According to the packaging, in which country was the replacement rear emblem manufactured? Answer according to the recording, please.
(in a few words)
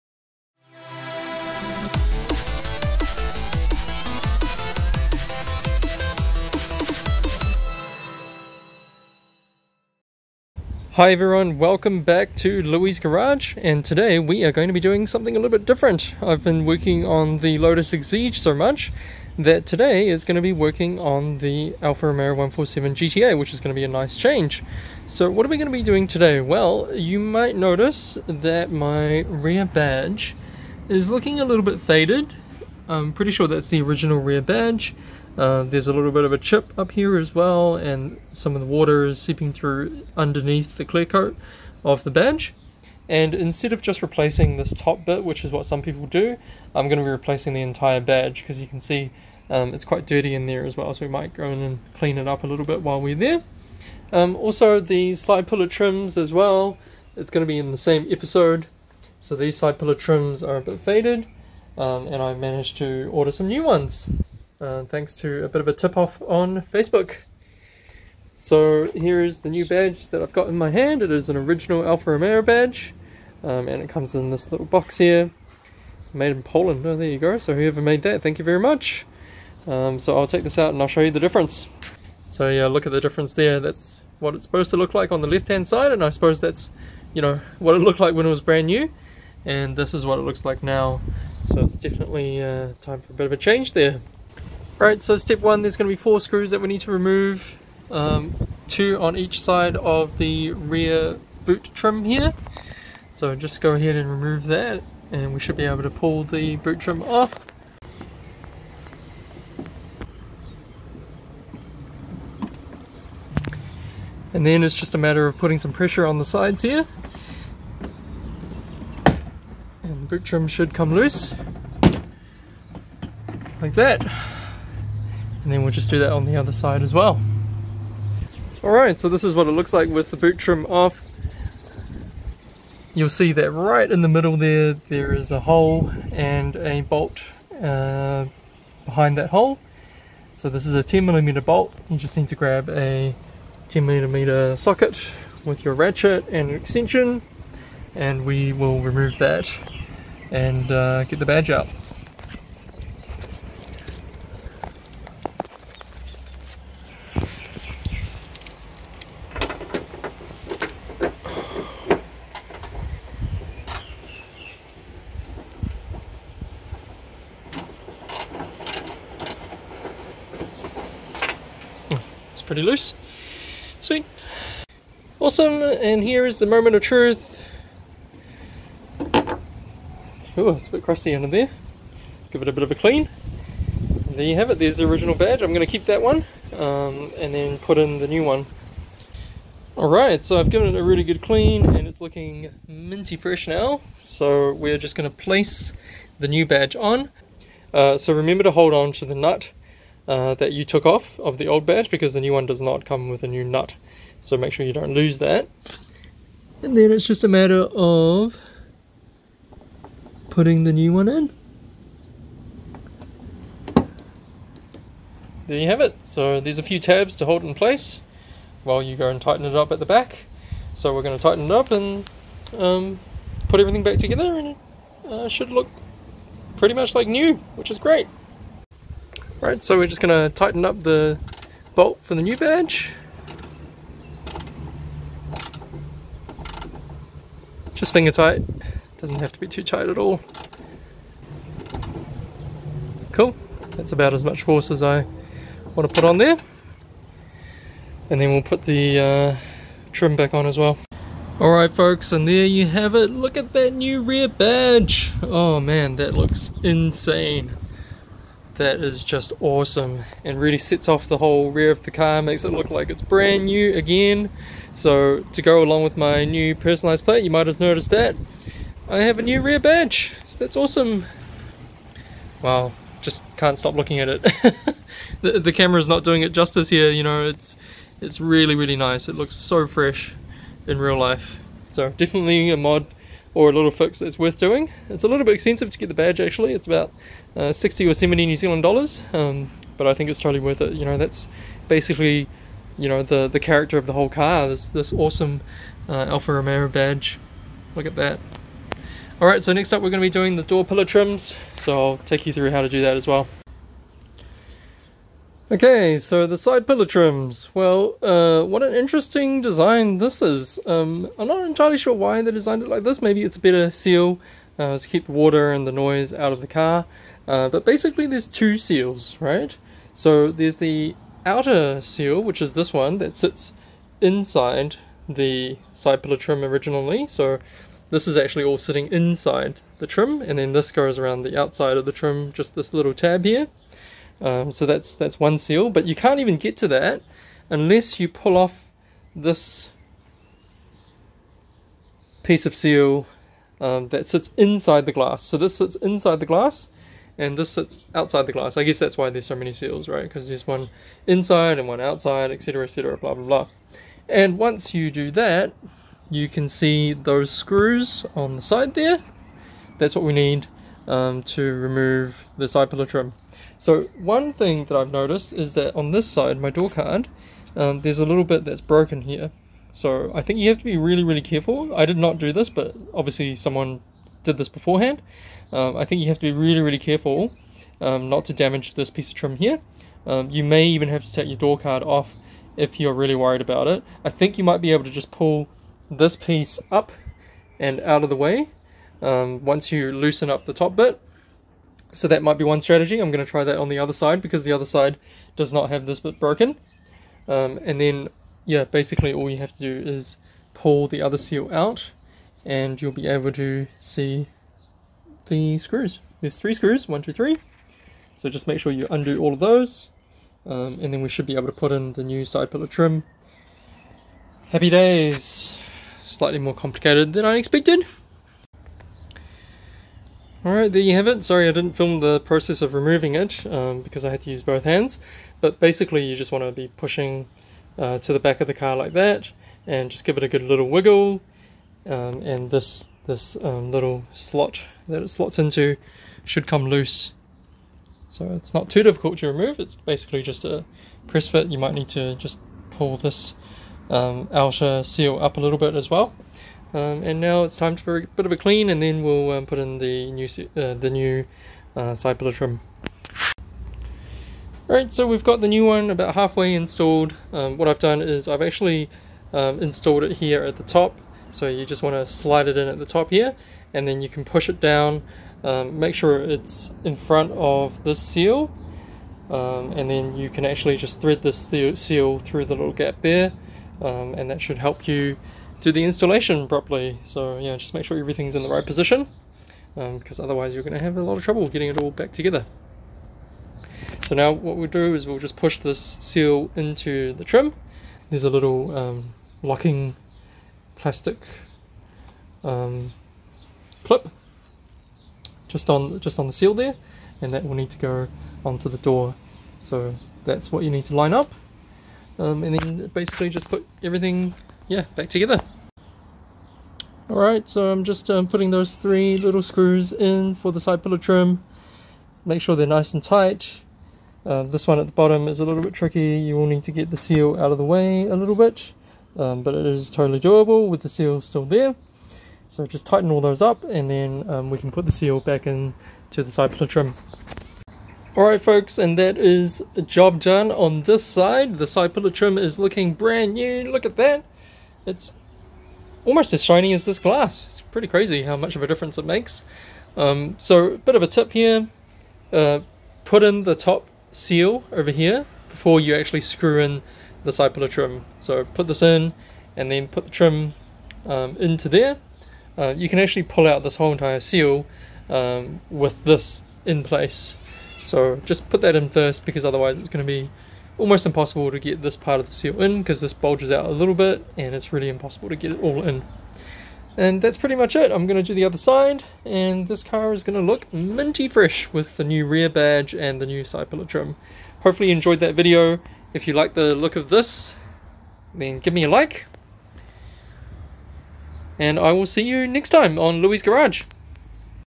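Poland.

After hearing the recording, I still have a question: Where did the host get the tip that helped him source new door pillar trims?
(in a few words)
Facebook.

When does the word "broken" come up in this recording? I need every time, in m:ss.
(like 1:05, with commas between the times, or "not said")
6:08, 6:36.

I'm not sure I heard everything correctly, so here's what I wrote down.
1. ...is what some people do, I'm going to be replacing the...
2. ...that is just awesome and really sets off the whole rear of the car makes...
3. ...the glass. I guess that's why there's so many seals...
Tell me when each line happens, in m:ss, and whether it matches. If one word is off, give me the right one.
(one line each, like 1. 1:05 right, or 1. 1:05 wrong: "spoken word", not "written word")
1. 0:45 right
2. 4:18 right
3. 5:48 right.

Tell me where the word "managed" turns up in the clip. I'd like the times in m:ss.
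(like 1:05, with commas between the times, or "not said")
1:02.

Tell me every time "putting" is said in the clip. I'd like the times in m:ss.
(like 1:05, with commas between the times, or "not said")
1:55, 3:30, 8:28.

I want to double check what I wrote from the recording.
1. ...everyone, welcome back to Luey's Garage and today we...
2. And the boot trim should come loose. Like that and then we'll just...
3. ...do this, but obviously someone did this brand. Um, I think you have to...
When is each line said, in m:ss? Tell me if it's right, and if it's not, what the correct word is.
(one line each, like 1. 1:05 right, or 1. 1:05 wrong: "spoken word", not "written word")
1. 0:11 right
2. 1:59 right
3. 6:12 wrong: "beforehand", not "brand".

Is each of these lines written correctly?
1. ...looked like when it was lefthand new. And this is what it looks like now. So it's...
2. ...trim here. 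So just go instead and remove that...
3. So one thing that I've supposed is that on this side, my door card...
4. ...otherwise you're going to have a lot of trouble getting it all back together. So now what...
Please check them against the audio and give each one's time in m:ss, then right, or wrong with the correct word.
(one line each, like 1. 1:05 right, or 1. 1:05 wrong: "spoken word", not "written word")
1. 1:27 wrong: "brand", not "lefthand"
2. 1:41 wrong: "ahead", not "instead"
3. 6:03 wrong: "noticed", not "supposed"
4. 8:00 right.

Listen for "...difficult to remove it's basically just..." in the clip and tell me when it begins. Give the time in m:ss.
7:18.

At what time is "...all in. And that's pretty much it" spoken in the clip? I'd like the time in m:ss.
9:25.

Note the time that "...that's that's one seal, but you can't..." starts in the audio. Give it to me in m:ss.
5:34.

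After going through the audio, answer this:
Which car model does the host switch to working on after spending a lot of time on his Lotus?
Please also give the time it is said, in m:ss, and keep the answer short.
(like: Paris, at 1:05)
Alfa Romeo 147 GTA, at 0:21.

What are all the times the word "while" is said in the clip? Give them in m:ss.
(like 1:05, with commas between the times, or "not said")
0:52, 3:38.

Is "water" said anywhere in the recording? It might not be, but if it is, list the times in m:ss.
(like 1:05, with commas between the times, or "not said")
0:38, 5:15.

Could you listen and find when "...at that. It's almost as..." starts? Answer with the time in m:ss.
8:53.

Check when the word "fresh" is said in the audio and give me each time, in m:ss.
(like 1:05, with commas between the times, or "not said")
3:13, 4:39, 9:31.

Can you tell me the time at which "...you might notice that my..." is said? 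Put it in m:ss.
0:26.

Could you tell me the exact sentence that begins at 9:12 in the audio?
Uh, you can actually pull out this whole entire seal um, with this in place.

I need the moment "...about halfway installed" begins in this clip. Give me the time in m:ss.
7:35.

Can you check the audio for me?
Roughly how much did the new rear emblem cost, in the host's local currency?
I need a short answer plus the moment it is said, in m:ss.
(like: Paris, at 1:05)
60 or 70 New Zealand dollars, at 4:47.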